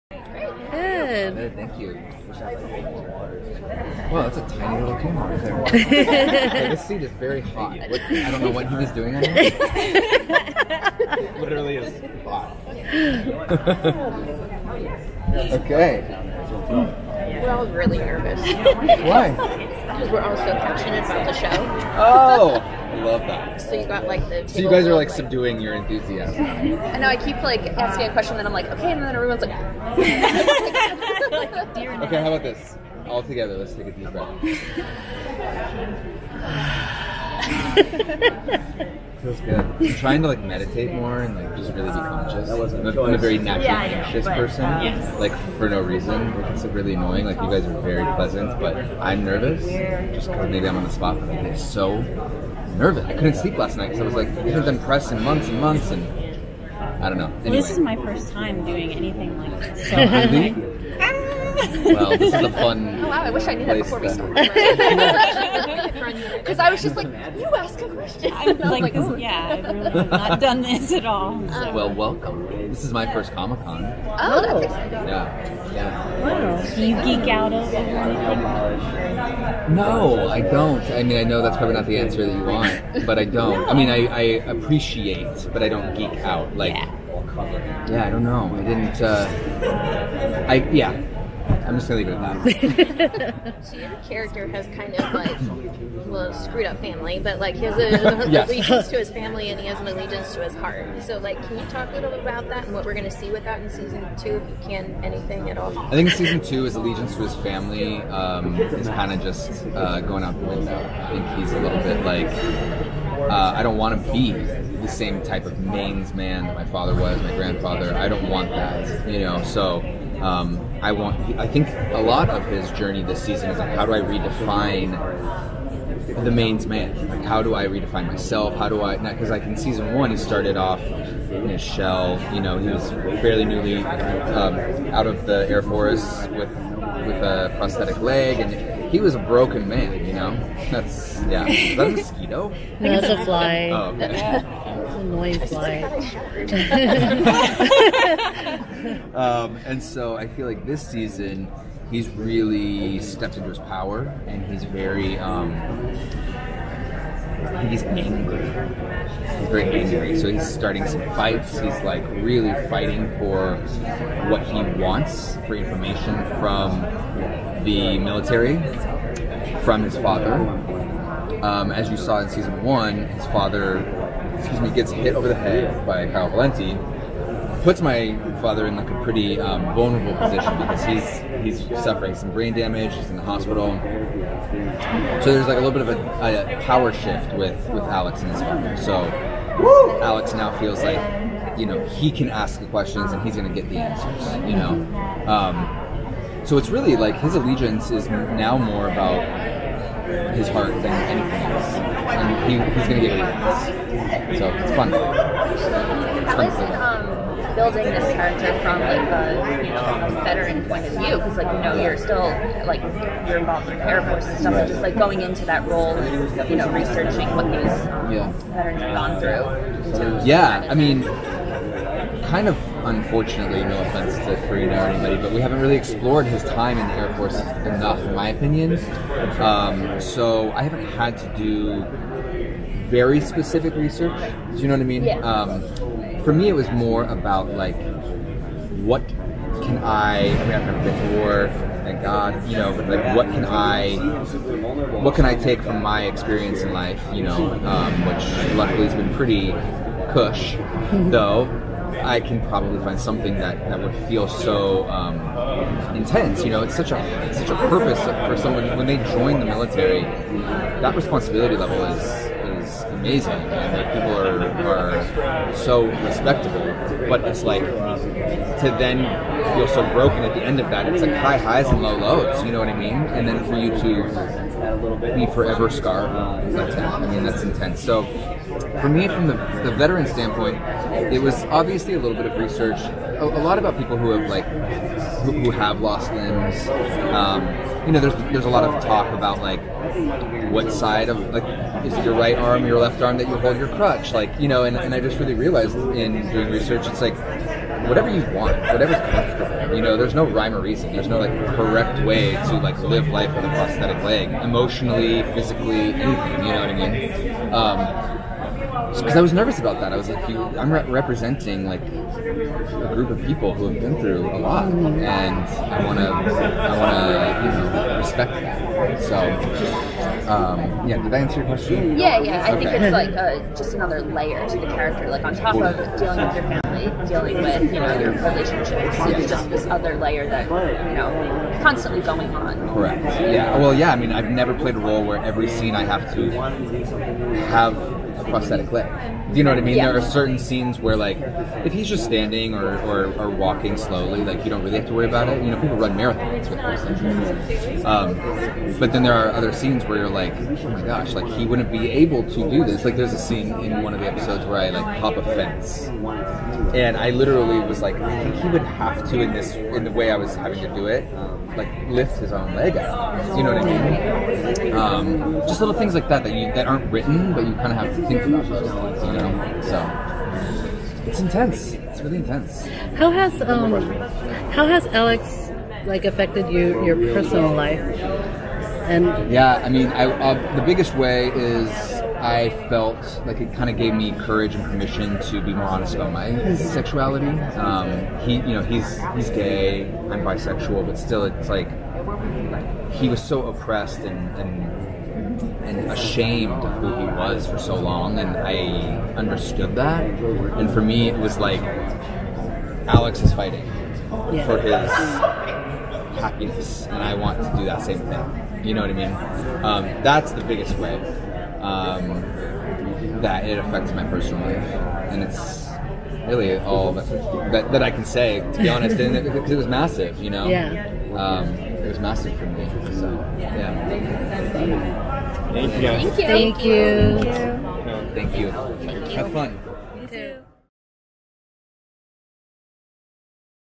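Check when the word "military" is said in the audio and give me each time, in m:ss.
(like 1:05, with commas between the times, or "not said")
2:47, 4:19.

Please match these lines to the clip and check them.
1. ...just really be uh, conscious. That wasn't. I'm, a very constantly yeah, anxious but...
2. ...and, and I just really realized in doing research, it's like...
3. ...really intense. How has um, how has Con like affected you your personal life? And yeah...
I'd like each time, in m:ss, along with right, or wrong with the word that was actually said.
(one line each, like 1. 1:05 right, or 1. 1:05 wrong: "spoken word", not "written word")
1. 0:41 wrong: "naturally", not "constantly"
2. 4:54 right
3. 6:12 wrong: "Alex", not "Con".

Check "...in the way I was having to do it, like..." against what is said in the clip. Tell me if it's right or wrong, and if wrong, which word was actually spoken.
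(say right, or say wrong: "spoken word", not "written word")
right.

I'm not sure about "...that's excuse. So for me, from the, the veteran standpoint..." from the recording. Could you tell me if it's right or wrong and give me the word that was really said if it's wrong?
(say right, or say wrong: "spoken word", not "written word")
wrong: "intense", not "excuse".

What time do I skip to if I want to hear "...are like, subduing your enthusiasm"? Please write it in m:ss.
0:24.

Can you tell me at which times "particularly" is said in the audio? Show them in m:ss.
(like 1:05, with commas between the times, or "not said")
not said.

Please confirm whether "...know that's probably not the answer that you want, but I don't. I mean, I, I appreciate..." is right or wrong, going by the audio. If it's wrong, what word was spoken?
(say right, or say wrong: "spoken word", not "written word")
right.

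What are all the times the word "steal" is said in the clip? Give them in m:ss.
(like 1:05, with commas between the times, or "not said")
not said.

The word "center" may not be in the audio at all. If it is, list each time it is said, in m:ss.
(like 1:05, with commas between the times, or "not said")
not said.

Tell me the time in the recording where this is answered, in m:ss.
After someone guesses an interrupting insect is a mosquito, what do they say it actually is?
2:23.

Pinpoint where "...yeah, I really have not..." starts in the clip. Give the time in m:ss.
1:09.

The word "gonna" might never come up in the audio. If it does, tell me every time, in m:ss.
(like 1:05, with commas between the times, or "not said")
1:31, 1:42.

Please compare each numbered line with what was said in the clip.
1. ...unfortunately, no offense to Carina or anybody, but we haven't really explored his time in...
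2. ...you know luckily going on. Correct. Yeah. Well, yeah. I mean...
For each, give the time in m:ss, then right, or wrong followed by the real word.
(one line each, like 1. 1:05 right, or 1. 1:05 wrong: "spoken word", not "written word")
1. 3:42 right
2. 5:30 wrong: "constantly", not "luckily".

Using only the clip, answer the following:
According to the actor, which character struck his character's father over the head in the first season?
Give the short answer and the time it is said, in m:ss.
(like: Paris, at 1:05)
Kyle Valenti, at 2:56.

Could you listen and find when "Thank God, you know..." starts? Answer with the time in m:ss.
4:01.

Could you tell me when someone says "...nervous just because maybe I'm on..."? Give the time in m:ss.
0:49.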